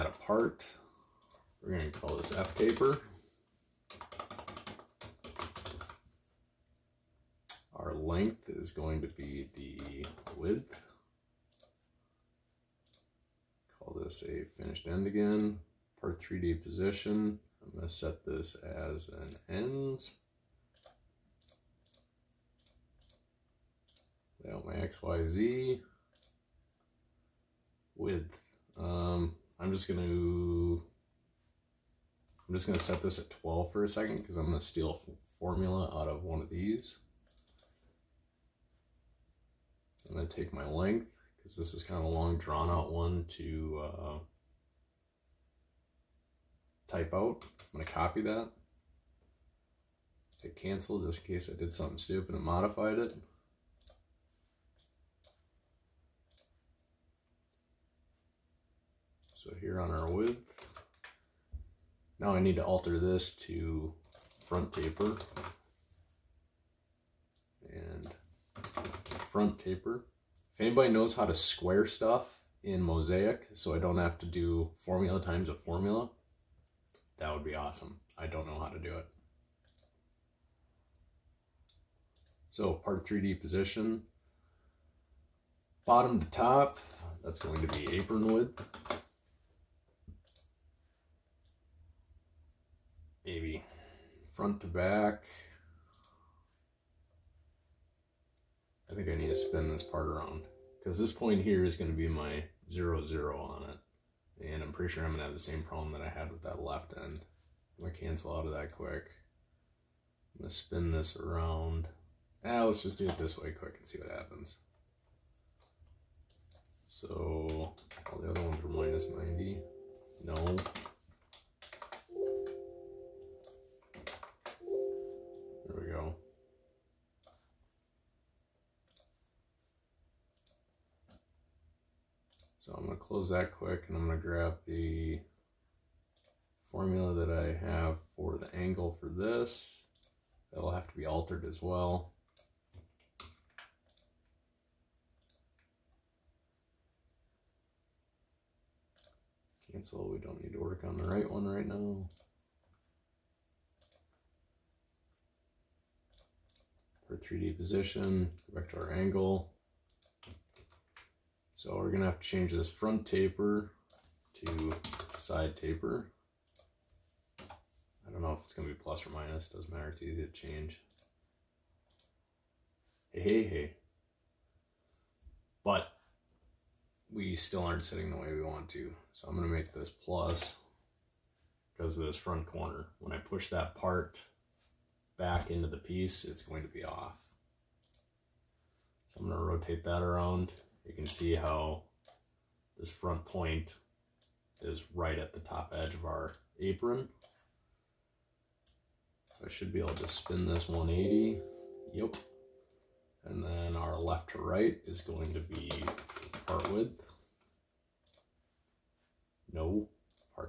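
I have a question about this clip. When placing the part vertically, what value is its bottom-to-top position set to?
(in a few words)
apron width.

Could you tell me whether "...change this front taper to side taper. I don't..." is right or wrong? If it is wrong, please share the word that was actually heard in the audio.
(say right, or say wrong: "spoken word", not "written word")
right.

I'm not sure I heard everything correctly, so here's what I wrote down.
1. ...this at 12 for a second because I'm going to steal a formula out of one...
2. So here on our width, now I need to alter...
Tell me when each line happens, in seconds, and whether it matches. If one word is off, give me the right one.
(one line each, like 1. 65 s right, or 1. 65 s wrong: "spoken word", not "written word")
1. 33 s right
2. 59 s right.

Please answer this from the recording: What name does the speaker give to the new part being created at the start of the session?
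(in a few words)
F taper.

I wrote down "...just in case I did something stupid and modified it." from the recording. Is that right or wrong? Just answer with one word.
right.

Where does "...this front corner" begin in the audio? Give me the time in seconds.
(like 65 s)
182 s.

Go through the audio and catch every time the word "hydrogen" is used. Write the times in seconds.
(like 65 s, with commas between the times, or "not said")
not said.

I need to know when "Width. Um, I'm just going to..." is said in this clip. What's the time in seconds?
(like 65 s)
27 s.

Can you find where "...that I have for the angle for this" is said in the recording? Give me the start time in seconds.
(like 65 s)
137 s.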